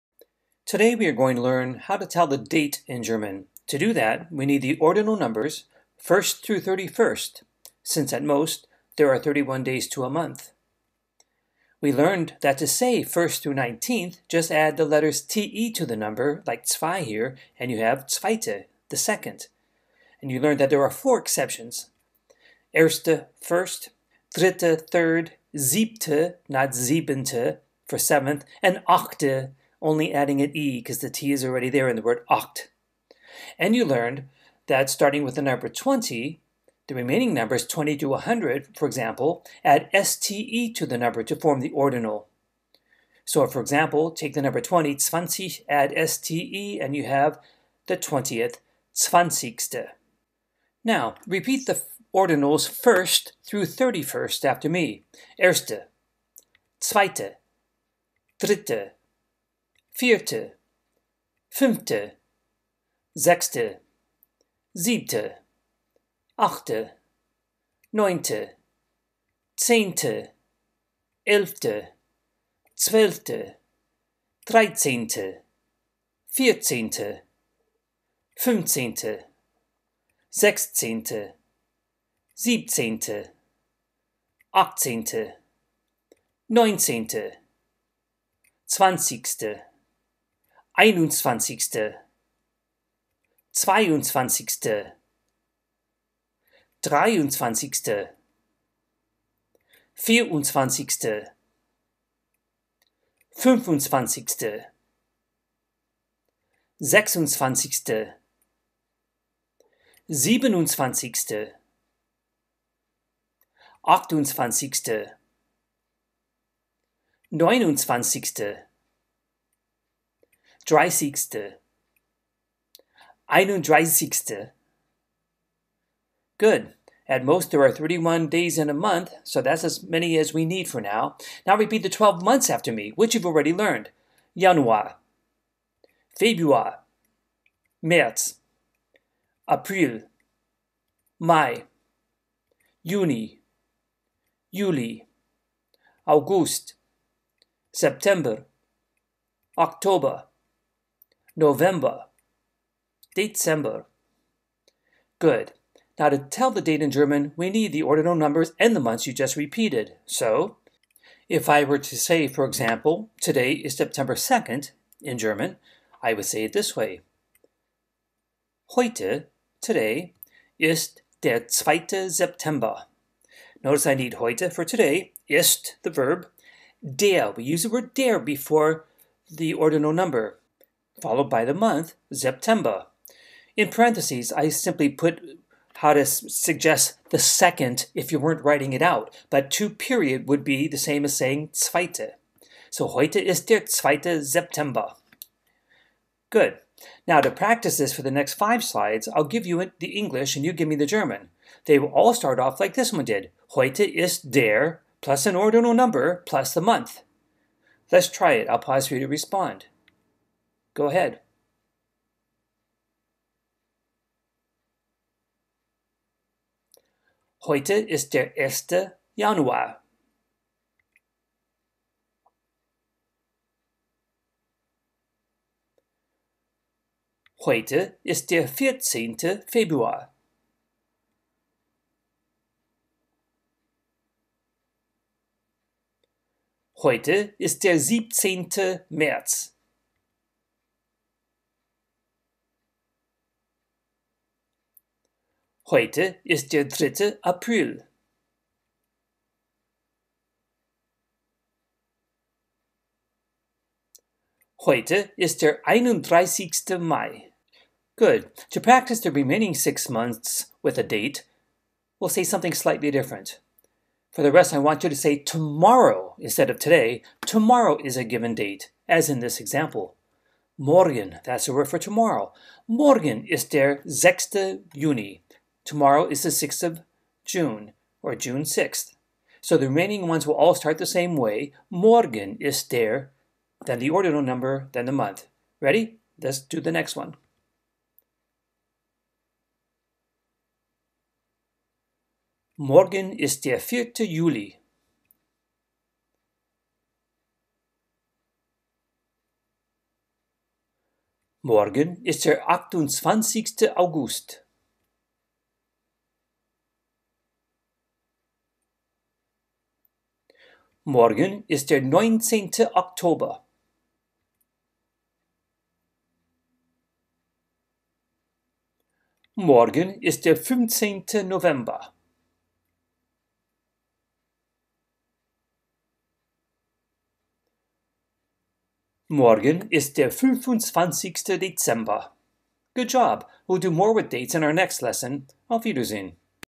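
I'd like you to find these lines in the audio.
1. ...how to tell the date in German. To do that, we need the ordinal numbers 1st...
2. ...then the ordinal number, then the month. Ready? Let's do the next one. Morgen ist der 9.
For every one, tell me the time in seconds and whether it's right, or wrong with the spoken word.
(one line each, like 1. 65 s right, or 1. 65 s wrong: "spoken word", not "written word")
1. 1 s right
2. 283 s wrong: "4", not "9".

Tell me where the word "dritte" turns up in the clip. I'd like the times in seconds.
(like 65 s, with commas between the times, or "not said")
24 s, 58 s, 246 s.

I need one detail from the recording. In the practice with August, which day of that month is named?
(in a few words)
28th.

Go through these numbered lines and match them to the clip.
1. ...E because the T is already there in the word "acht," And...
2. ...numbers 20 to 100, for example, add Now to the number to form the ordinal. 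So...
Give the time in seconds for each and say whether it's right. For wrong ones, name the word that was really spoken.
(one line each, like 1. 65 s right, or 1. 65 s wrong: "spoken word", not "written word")
1. 30 s right
2. 37 s wrong: "STE", not "Now".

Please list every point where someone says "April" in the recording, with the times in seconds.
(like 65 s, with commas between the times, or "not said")
139 s, 247 s.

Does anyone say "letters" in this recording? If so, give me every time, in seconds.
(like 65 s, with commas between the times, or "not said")
14 s.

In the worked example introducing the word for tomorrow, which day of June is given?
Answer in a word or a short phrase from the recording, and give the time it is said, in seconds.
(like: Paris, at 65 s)
6th, at 272 s.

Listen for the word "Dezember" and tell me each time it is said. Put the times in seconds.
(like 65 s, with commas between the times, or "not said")
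153 s, 331 s.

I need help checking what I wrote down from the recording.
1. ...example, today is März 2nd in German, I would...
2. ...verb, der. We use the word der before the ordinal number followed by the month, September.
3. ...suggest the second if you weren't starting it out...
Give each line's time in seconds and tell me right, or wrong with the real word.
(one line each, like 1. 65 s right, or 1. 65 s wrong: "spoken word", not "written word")
1. 162 s wrong: "September", not "März"
2. 175 s right
3. 186 s wrong: "writing", not "starting".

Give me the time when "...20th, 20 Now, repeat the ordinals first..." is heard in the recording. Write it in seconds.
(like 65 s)
47 s.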